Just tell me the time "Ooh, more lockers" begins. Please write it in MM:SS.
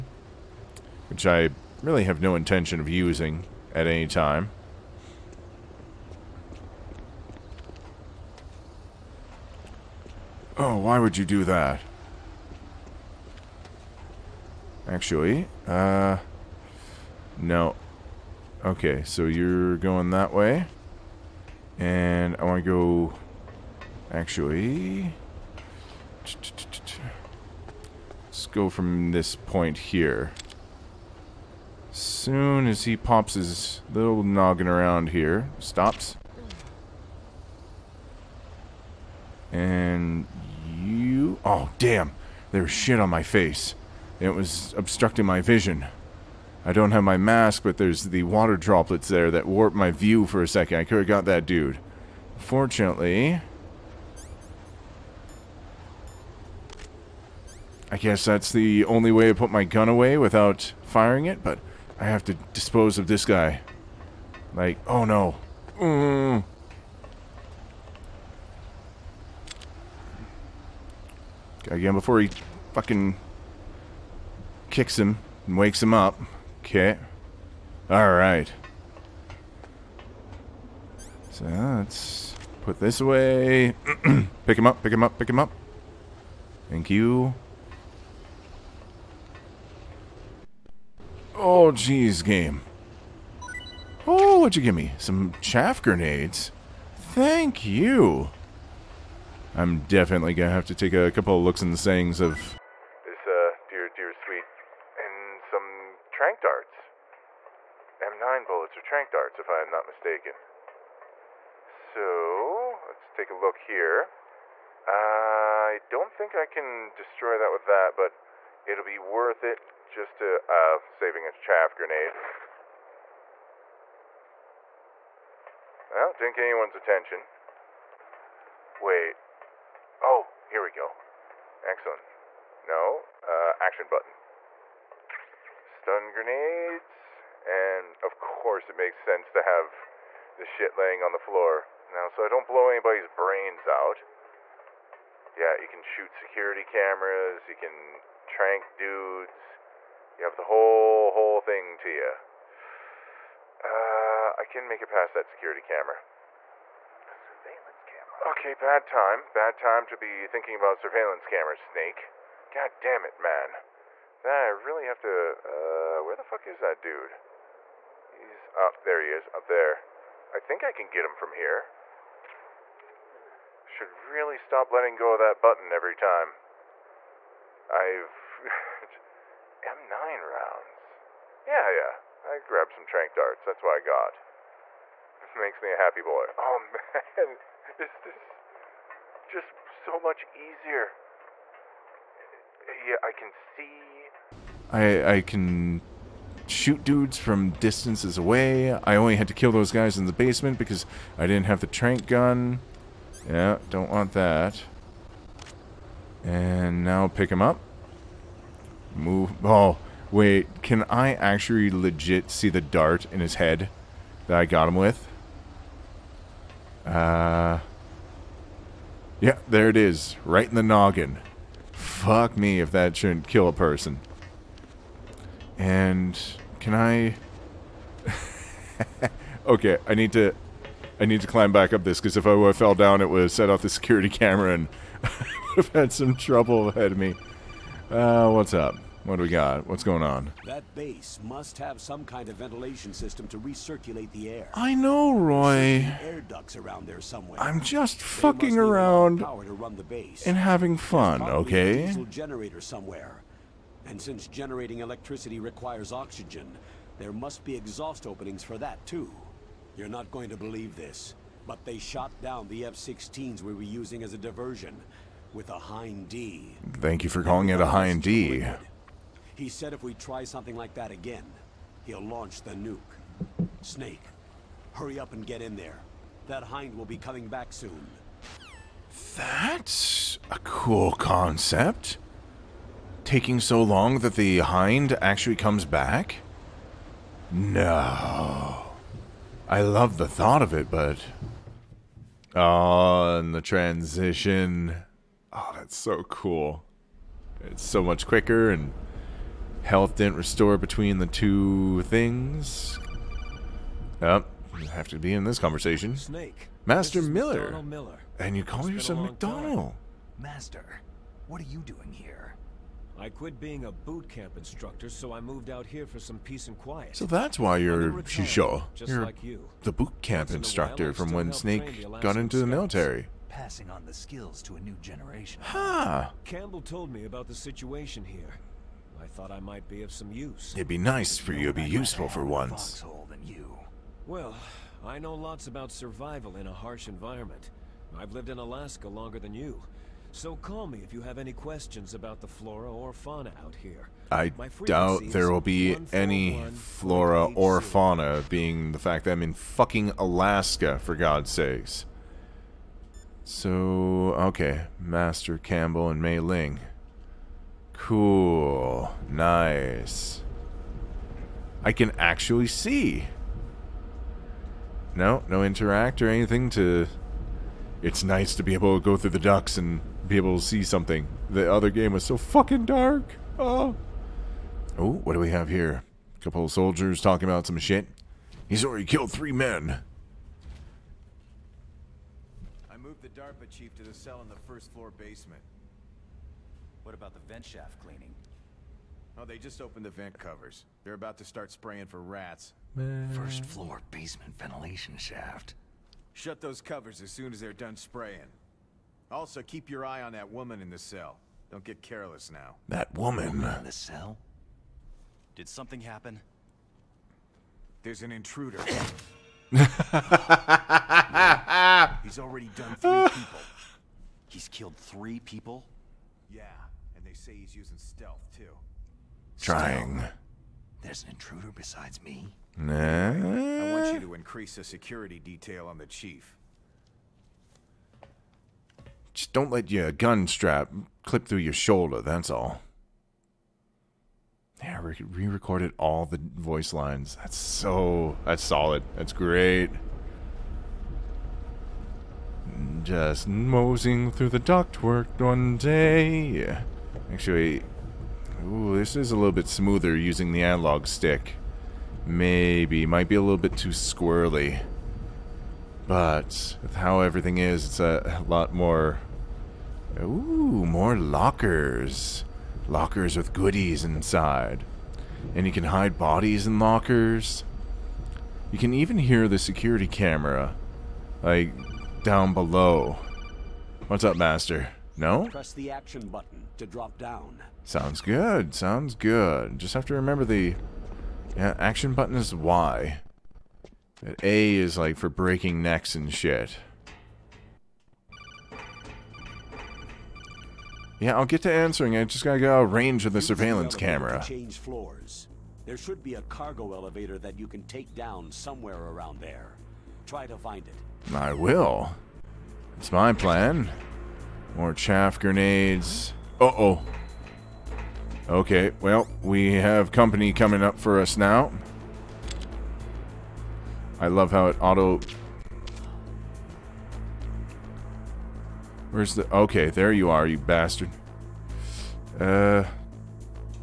07:39.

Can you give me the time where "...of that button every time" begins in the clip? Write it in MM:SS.
02:55.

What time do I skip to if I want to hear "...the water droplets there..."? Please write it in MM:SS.
00:48.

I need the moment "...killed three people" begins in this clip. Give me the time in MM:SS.
06:54.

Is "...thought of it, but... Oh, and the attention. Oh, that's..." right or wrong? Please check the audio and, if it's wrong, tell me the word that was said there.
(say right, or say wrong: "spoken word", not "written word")
wrong: "transition", not "attention".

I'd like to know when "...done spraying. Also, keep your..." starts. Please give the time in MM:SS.
06:37.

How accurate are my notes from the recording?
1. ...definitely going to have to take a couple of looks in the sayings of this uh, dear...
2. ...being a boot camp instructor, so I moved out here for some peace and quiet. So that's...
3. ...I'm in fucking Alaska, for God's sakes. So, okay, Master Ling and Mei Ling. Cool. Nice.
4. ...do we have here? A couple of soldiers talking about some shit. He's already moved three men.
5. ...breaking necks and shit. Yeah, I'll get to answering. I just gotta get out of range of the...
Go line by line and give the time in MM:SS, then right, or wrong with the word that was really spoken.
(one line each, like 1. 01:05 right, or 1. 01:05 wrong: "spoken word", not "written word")
1. 01:39 right
2. 05:13 right
3. 05:49 wrong: "Campbell", not "Ling"
4. 06:15 wrong: "killed", not "moved"
5. 08:05 right.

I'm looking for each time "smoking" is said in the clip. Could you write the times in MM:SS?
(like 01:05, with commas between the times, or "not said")
not said.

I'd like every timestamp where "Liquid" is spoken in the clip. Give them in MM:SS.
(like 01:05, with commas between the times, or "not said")
04:28.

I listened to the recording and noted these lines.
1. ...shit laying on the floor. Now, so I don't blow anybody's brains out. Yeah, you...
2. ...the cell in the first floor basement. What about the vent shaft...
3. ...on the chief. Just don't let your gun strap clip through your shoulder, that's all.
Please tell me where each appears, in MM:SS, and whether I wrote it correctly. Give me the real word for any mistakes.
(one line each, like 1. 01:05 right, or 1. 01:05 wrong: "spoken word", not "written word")
1. 02:20 right
2. 06:23 right
3. 07:05 right.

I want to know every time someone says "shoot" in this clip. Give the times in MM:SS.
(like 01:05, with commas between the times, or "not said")
02:25, 03:16.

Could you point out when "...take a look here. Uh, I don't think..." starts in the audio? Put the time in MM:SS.
01:53.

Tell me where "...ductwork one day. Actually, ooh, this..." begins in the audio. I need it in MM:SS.
07:24.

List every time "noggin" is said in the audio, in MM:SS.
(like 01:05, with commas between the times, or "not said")
00:34, 03:40.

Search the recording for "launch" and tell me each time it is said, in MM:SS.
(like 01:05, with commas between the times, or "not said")
04:32.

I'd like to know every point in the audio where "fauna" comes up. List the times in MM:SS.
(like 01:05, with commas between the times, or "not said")
05:42, 05:47.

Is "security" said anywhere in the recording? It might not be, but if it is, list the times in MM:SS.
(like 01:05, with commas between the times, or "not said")
02:26, 02:35, 03:53, 07:04, 07:49.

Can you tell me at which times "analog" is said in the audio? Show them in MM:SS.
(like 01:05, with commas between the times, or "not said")
07:30.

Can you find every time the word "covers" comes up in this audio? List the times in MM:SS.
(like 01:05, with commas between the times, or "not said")
06:30, 06:36.